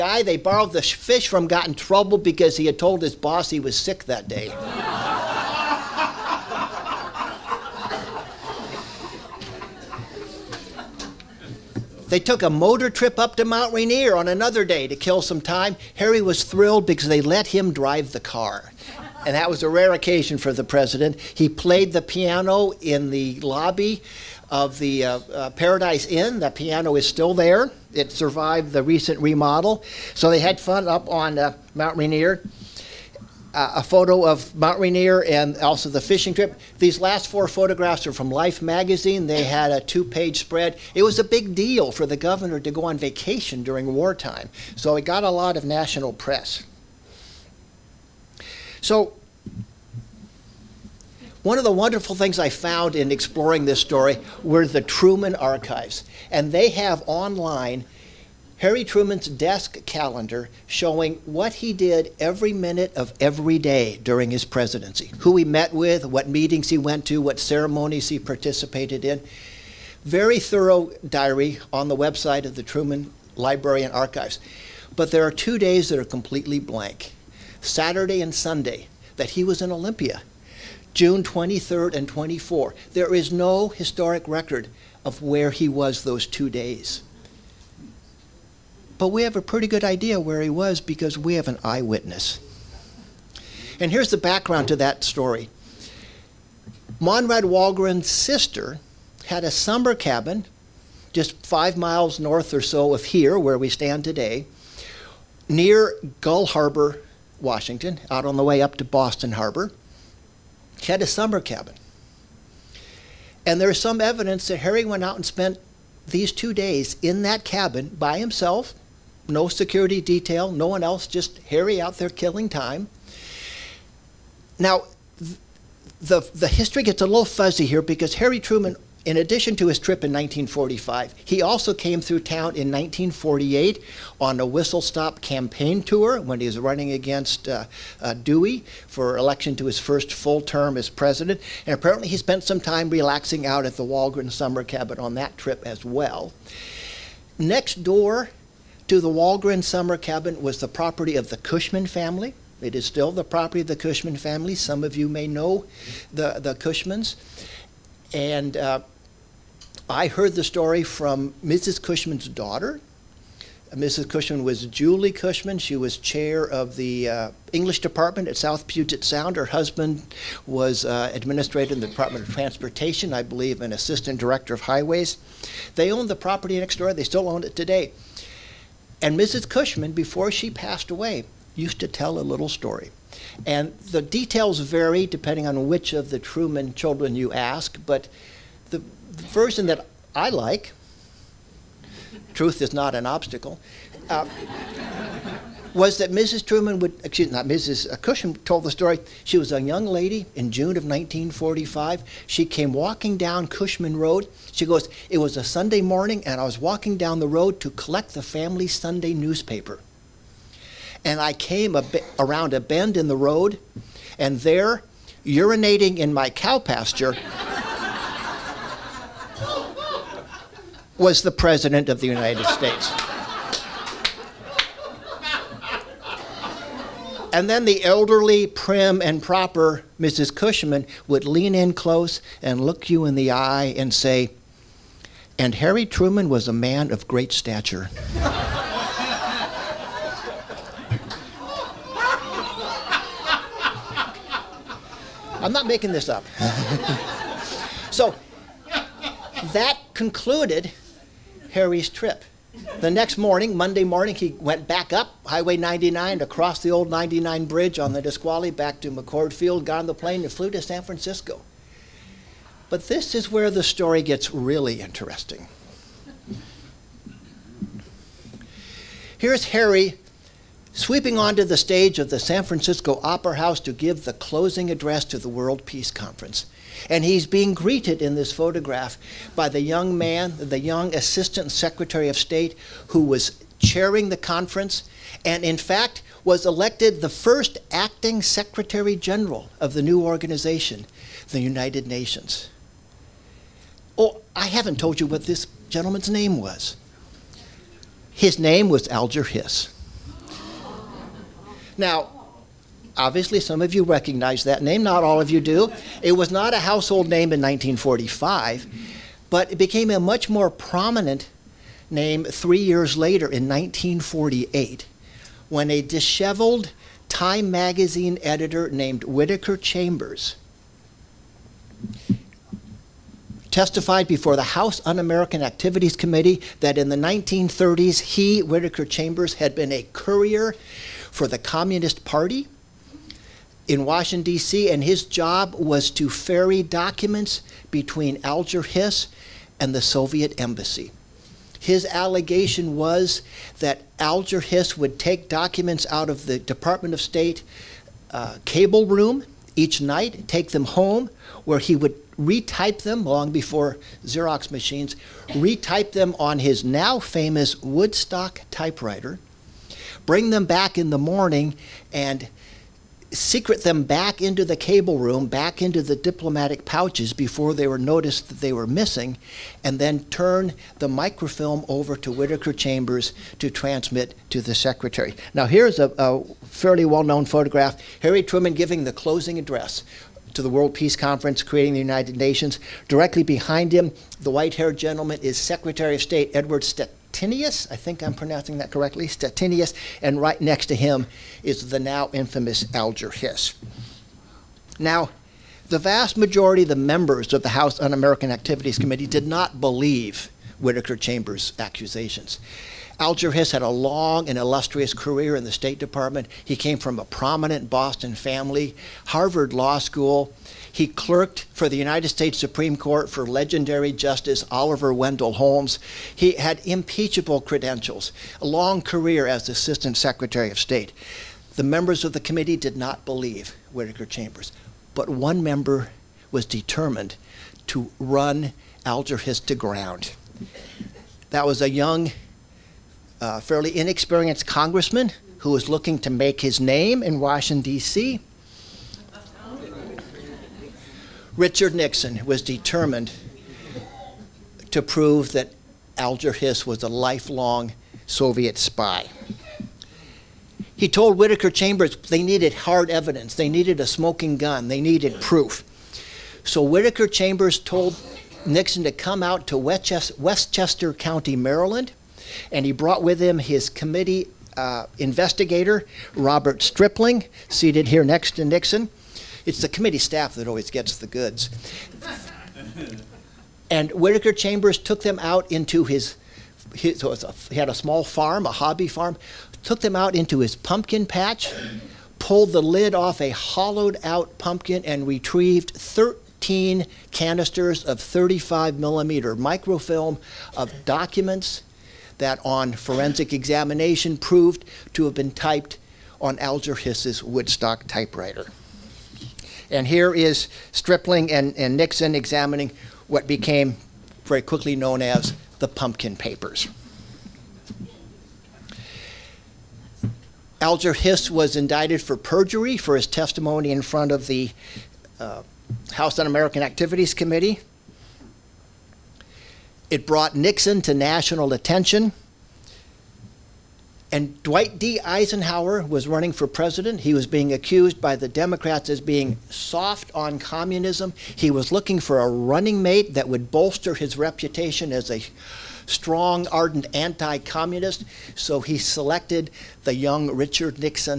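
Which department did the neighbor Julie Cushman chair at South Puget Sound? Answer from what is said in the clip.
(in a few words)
English.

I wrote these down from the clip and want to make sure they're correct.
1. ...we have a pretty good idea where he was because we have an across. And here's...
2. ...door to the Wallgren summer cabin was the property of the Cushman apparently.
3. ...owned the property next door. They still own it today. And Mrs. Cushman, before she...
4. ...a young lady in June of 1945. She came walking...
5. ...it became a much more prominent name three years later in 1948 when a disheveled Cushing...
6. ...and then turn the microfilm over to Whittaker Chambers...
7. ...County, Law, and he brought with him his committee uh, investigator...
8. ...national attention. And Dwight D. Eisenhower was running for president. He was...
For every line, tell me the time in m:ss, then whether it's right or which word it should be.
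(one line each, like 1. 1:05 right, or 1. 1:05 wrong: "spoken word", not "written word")
1. 1:29 wrong: "eyewitness", not "across"
2. 2:27 wrong: "family", not "apparently"
3. 2:55 right
4. 3:19 right
5. 5:09 wrong: "Time", not "Cushing"
6. 6:09 right
7. 7:40 wrong: "Maryland", not "Law"
8. 8:40 right.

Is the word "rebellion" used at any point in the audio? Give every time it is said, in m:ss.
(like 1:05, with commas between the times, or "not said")
not said.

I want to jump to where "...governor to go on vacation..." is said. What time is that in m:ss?
0:42.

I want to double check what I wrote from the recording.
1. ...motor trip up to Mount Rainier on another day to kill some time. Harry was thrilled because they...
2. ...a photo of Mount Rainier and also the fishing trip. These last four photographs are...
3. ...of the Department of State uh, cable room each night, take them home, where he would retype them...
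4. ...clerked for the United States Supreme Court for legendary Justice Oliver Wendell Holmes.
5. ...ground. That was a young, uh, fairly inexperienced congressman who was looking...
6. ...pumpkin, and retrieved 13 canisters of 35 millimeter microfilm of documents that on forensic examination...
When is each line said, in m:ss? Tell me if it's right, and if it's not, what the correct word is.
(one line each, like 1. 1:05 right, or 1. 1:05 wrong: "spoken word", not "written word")
1. 0:12 right
2. 0:33 right
3. 5:46 right
4. 6:50 right
5. 7:09 right
6. 8:04 right.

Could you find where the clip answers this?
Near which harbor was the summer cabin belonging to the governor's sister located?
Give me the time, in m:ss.
1:46.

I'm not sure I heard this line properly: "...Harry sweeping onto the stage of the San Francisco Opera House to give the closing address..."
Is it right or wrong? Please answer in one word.
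right.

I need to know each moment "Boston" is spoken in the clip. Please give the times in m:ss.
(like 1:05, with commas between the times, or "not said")
1:48, 6:47.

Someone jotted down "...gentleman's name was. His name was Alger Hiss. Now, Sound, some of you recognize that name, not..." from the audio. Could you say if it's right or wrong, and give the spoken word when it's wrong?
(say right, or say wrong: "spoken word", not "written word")
wrong: "Obviously", not "Sound".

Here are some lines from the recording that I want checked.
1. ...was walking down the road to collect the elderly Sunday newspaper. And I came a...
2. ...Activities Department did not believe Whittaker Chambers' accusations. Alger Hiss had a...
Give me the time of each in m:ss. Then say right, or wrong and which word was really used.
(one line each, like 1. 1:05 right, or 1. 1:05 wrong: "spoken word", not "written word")
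1. 3:26 wrong: "family", not "elderly"
2. 6:38 wrong: "Committee", not "Department".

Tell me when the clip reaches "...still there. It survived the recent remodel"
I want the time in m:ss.
0:27.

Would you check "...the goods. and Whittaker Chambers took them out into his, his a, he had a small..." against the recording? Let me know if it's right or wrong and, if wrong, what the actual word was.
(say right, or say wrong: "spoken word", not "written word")
right.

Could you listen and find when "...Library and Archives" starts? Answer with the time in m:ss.
1:13.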